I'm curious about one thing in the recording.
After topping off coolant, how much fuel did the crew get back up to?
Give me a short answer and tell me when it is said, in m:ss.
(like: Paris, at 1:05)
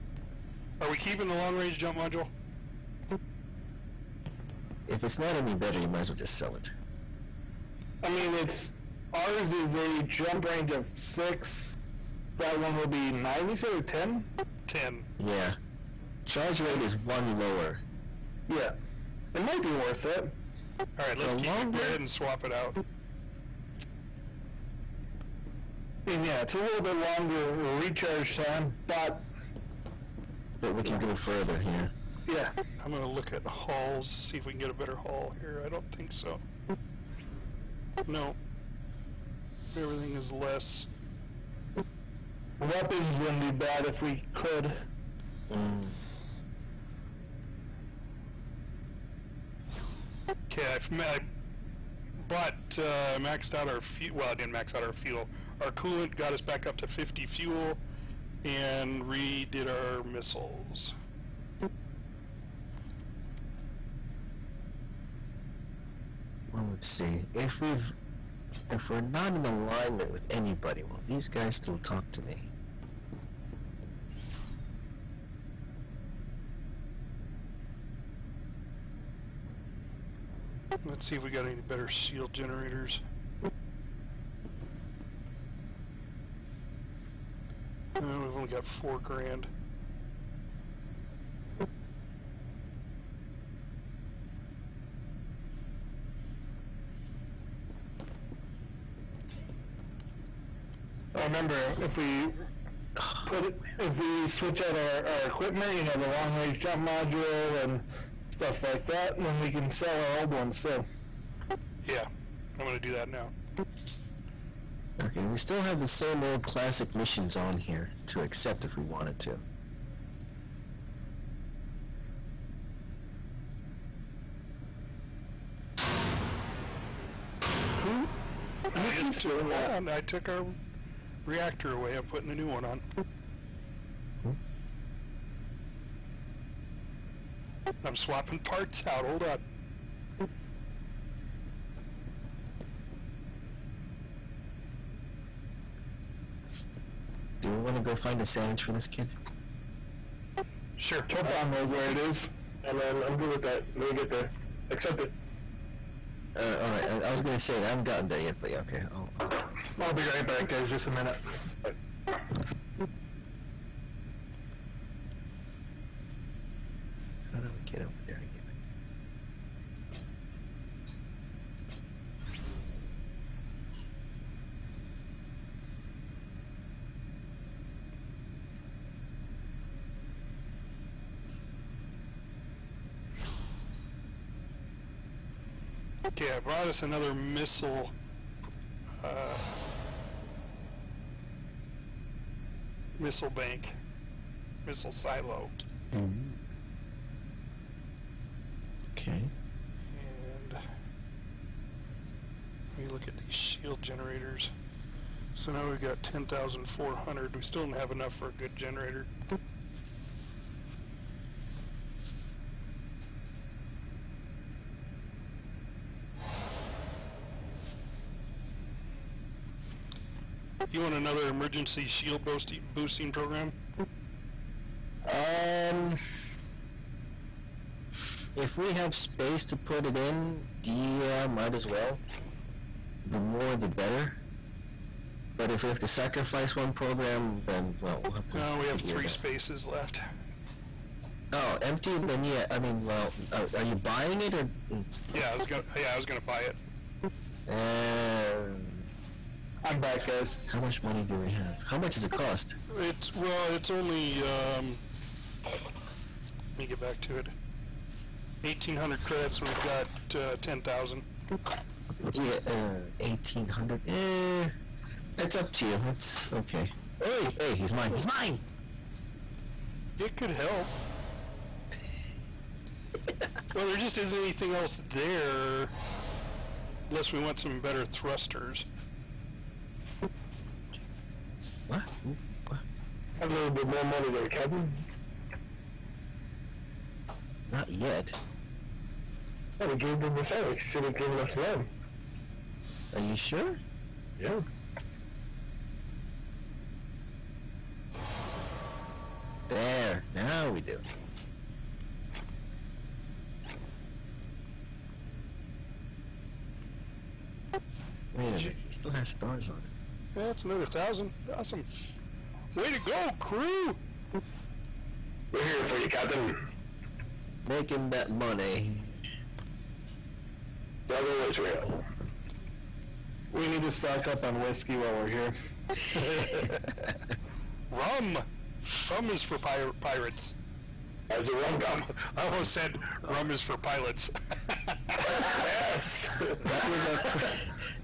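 50, at 0:56.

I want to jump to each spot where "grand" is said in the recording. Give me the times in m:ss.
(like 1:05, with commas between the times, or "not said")
1:29.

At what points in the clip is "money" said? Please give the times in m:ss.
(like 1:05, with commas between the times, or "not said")
4:10, 4:43, 5:18.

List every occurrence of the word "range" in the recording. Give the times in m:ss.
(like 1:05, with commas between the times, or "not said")
0:01, 0:10, 1:46.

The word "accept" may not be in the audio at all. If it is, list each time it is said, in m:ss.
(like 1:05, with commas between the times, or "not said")
1:58, 2:34.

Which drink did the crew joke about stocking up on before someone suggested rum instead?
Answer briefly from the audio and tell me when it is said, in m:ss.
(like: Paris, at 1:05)
Whiskey, at 5:24.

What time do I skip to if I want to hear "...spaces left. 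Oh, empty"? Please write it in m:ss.
3:59.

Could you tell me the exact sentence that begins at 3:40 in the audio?
you want another emergency shield boosting, program?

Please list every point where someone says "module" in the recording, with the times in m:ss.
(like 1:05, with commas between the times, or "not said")
0:01, 1:46.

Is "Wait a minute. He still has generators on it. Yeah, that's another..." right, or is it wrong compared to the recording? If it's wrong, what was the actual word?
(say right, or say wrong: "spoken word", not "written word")
wrong: "stars", not "generators".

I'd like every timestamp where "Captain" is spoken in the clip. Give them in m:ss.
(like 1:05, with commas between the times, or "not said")
4:44, 5:15.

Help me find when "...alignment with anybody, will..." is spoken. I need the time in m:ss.
1:09.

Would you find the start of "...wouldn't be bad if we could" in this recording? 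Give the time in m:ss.
0:43.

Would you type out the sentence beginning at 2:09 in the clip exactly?
On, I took our reactor away.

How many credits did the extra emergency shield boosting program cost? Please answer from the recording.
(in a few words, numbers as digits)
1,800 credits.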